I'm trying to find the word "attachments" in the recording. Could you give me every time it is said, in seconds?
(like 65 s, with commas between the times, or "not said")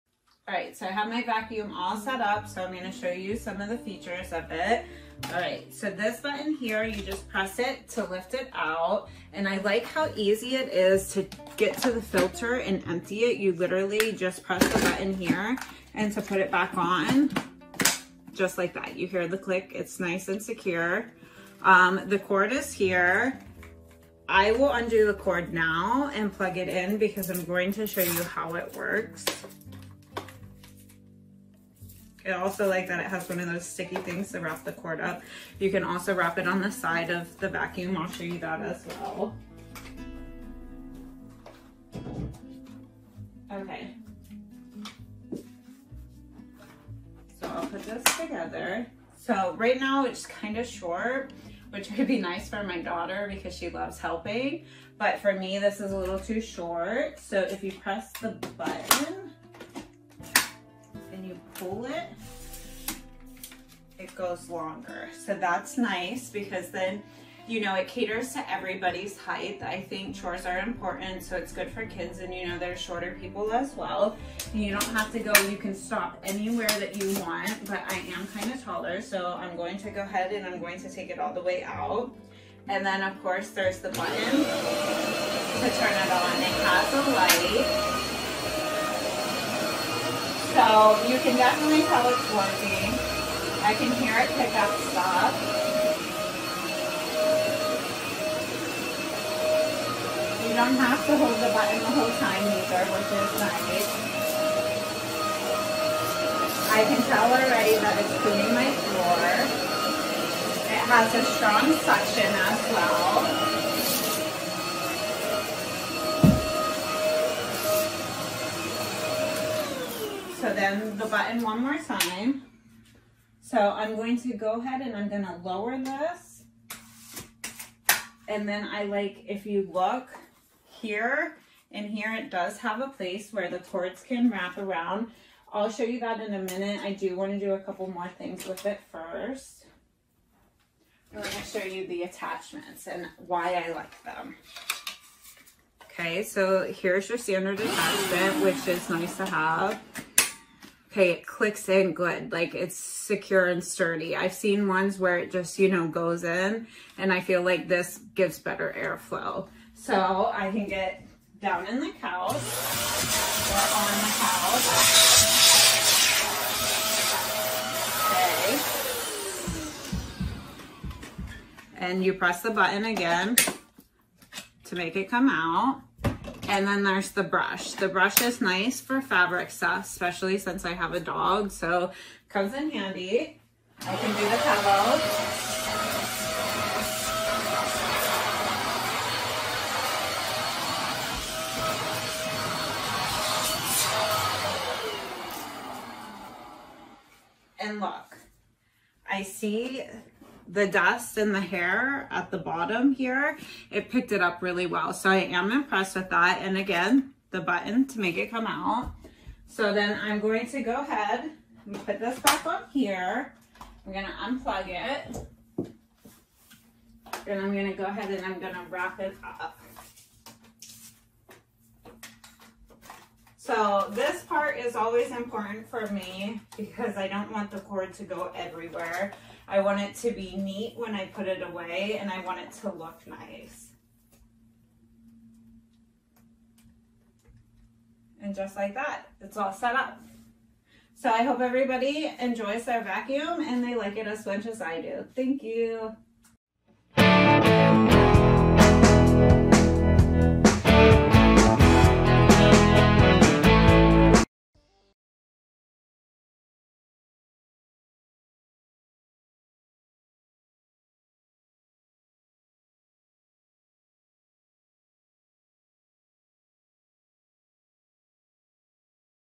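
142 s, 147 s.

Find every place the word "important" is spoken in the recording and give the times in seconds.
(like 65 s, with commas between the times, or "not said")
70 s, 225 s.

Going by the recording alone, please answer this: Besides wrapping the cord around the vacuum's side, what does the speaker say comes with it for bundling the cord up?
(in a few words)
sticky things.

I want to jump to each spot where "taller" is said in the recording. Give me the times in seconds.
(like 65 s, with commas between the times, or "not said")
78 s.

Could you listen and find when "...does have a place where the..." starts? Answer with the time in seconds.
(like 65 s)
132 s.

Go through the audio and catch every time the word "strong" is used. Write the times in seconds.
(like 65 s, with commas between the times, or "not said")
111 s.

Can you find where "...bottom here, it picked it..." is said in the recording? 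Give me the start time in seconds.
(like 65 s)
202 s.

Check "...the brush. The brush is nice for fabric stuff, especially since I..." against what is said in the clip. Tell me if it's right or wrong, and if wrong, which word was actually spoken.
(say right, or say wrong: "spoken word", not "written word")
right.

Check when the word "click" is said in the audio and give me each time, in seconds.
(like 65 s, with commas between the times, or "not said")
19 s, 151 s.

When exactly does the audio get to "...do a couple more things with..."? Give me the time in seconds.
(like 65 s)
137 s.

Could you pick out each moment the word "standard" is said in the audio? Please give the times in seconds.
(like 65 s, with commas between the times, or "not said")
147 s.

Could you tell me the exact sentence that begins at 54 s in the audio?
But for me, this is a little too short.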